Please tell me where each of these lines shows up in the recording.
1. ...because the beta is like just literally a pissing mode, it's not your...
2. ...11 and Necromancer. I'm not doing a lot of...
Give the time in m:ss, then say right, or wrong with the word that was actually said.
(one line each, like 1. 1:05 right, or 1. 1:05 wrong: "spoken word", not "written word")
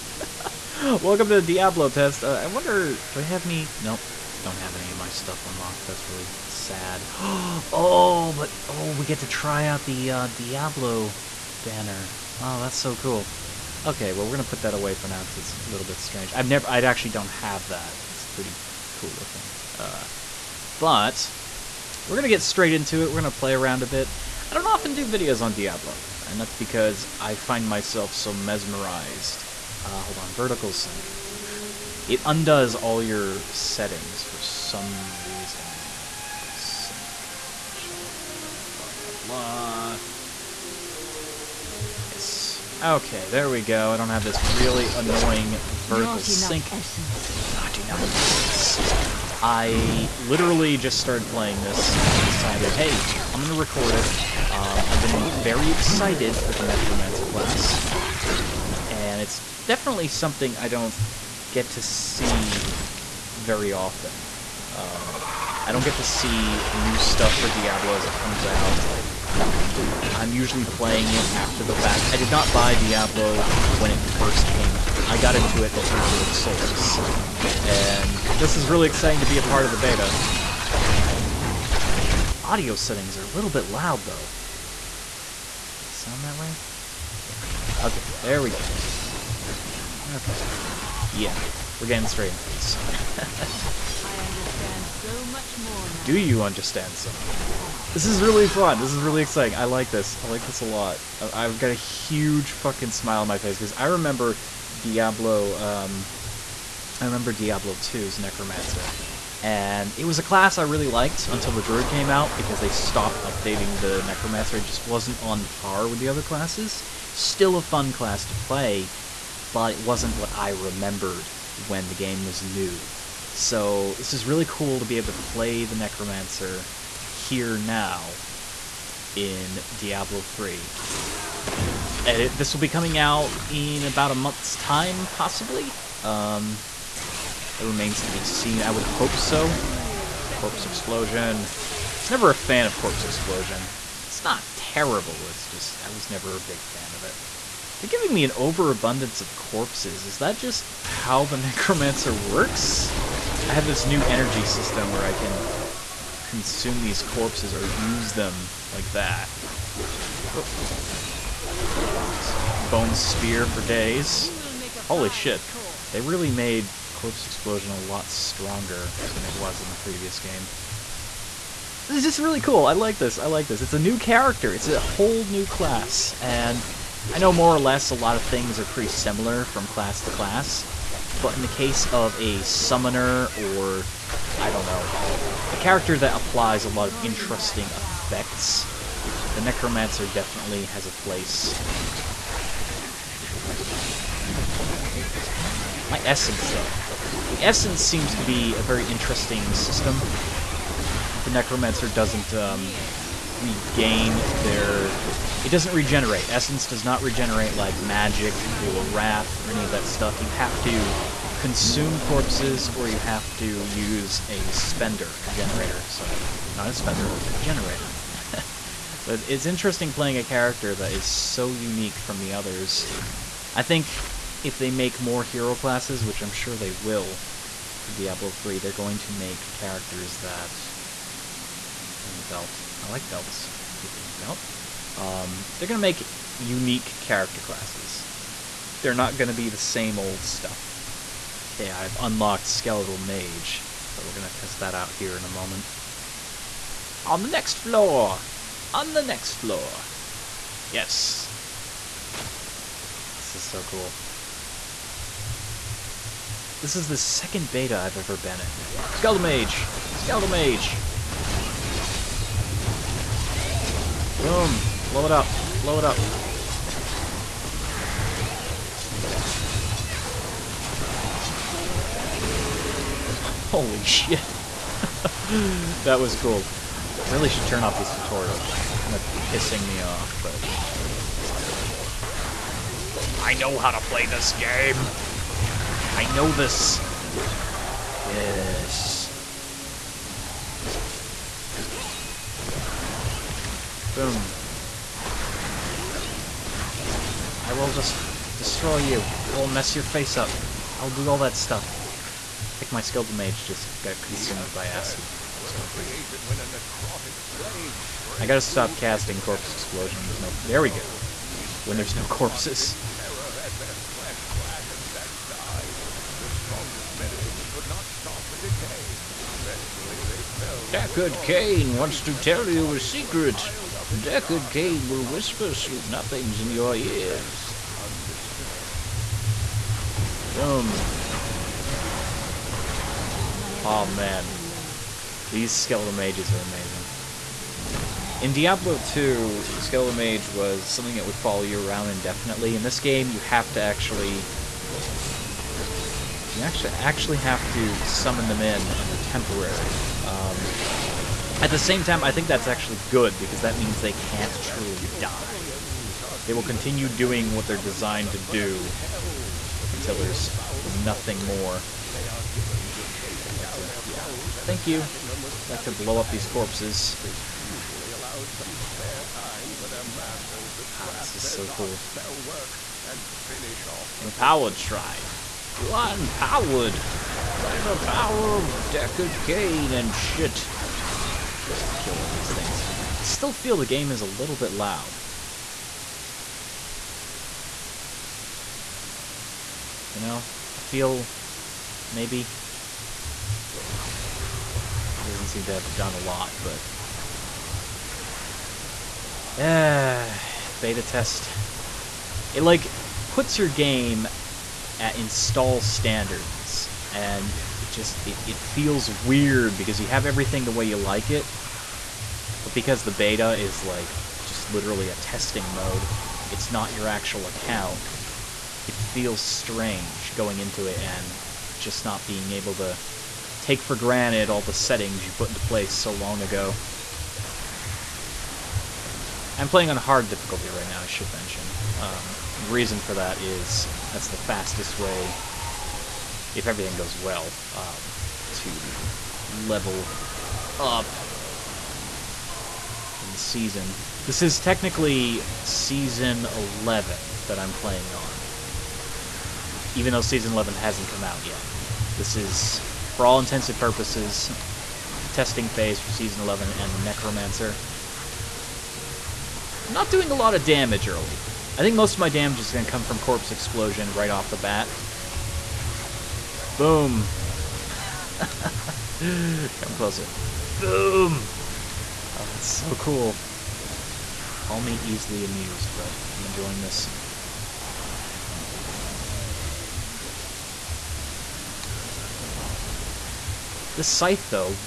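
1. 6:52 wrong: "testing", not "pissing"
2. 7:36 right.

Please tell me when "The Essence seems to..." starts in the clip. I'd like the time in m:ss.
3:17.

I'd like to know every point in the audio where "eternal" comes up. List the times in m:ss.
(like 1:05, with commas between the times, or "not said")
not said.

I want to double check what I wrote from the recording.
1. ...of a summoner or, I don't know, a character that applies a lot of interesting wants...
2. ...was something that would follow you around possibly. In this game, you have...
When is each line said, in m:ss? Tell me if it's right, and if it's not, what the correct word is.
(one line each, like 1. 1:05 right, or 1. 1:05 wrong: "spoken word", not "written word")
1. 3:01 wrong: "effects", not "wants"
2. 5:40 wrong: "indefinitely", not "possibly".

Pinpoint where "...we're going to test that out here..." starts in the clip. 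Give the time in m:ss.
4:04.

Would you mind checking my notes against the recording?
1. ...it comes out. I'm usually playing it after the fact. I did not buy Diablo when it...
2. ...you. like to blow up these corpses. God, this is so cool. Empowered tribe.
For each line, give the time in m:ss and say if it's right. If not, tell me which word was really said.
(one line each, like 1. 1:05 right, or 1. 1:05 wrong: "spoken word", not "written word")
1. 1:08 right
2. 6:04 right.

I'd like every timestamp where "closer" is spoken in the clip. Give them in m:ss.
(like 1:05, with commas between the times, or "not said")
7:49.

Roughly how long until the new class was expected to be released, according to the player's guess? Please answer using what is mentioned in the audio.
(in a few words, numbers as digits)
About a month.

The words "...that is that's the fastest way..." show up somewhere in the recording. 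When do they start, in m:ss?
7:12.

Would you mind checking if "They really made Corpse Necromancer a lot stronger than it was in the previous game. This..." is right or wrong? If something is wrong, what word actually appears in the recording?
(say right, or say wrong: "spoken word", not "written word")
wrong: "Explosion", not "Necromancer".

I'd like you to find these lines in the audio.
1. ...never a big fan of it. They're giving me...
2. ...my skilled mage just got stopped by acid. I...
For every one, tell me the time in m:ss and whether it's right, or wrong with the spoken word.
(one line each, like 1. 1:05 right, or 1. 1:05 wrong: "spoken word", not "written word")
1. 2:26 right
2. 5:02 wrong: "consumed", not "stopped".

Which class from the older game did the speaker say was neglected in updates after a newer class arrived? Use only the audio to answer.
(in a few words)
Druid.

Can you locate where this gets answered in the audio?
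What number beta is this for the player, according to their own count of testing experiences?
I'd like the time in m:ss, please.
4:16.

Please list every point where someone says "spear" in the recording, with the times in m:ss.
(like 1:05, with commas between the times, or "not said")
2:42.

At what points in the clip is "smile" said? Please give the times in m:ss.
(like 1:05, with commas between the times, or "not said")
1:42.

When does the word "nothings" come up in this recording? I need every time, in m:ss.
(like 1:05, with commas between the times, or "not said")
5:25, 6:00.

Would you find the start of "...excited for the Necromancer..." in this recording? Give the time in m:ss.
0:55.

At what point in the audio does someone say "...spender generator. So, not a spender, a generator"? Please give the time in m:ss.
3:34.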